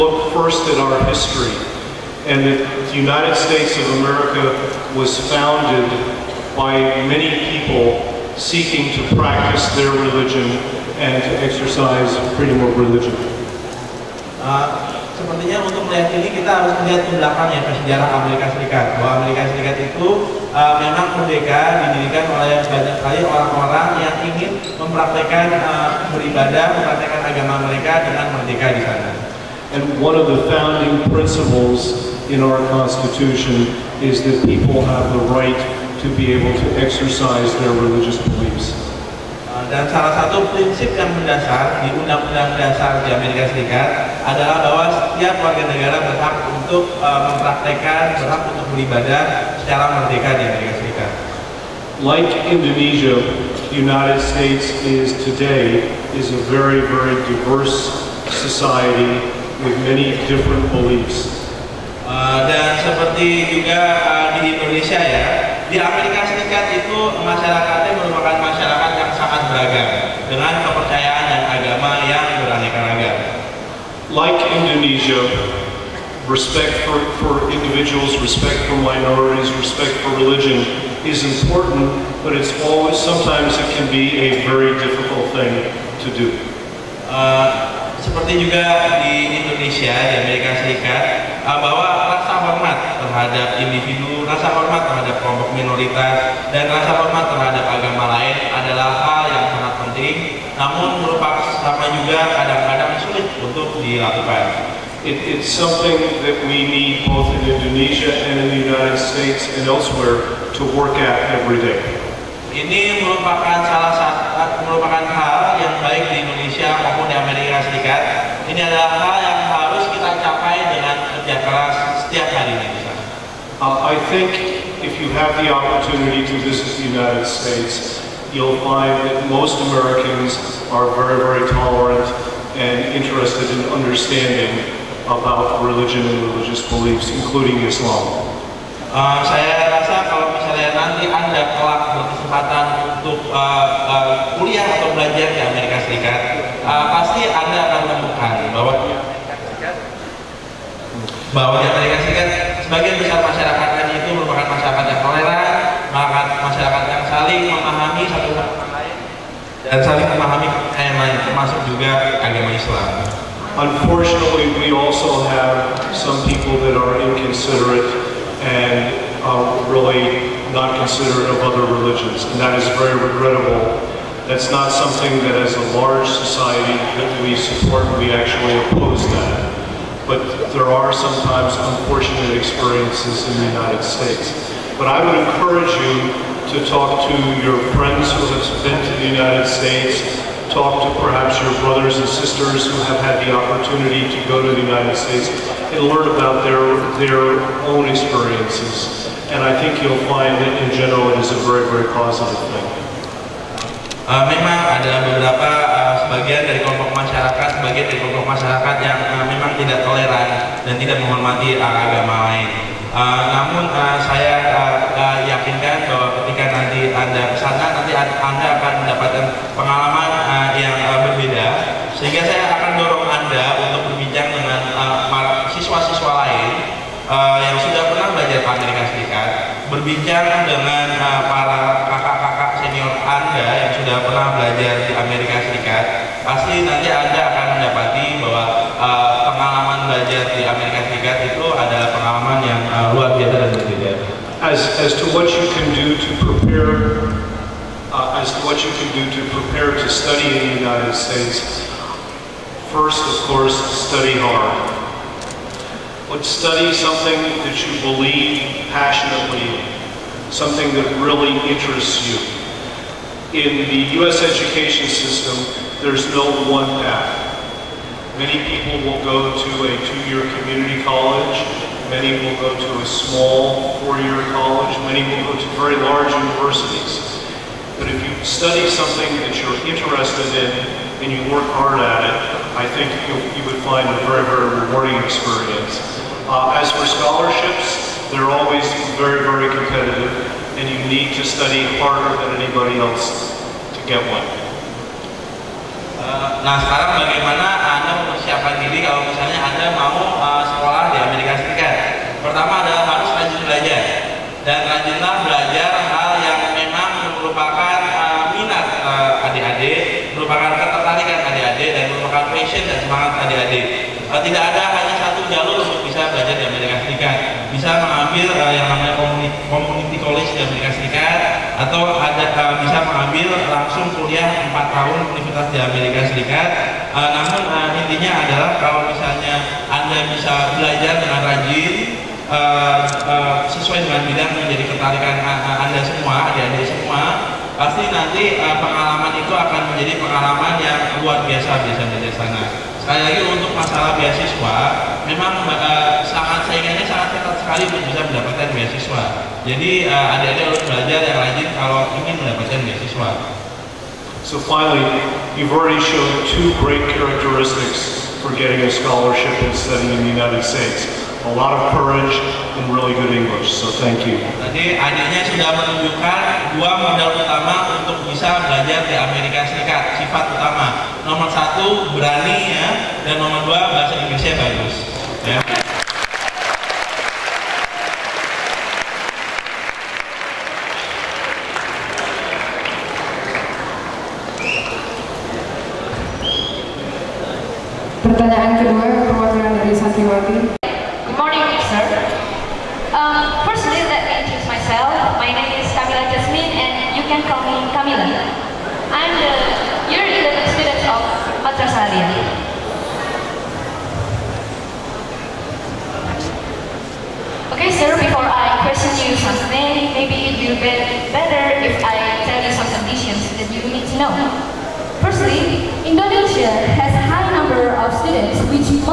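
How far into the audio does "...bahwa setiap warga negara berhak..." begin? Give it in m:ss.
0:44.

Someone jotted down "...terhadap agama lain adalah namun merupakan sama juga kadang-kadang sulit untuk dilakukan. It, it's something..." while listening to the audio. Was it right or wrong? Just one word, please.
right.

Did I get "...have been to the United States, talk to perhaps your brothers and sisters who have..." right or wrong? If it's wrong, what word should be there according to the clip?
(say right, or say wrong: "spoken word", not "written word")
right.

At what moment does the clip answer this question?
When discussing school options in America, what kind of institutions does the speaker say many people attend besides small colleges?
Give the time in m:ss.
4:35.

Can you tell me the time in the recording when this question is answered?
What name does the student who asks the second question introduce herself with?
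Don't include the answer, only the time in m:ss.
6:37.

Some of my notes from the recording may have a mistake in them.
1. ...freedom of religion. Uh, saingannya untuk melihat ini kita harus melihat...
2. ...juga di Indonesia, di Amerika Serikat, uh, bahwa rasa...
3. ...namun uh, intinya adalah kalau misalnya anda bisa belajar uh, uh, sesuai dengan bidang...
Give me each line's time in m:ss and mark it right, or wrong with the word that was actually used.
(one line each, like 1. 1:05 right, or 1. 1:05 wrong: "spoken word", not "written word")
1. 0:12 wrong: "sepertinya", not "saingannya"
2. 1:28 right
3. 5:27 right.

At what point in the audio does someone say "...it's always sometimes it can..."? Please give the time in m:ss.
1:22.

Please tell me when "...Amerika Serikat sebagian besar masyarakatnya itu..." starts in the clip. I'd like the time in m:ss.
2:31.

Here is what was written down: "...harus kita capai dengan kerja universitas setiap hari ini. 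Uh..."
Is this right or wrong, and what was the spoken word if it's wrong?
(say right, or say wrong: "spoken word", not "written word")
wrong: "keras", not "universitas".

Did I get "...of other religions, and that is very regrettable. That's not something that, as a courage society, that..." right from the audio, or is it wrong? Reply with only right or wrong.
wrong.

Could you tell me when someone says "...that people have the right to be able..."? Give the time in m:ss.
0:34.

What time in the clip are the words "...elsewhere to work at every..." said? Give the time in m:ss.
1:49.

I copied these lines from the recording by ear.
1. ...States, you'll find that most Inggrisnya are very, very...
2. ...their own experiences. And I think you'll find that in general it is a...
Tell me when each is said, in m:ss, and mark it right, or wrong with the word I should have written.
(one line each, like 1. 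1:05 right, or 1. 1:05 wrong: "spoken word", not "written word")
1. 2:07 wrong: "Americans", not "Inggrisnya"
2. 3:16 right.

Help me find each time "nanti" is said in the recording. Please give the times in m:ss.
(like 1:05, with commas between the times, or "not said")
2:20, 5:37.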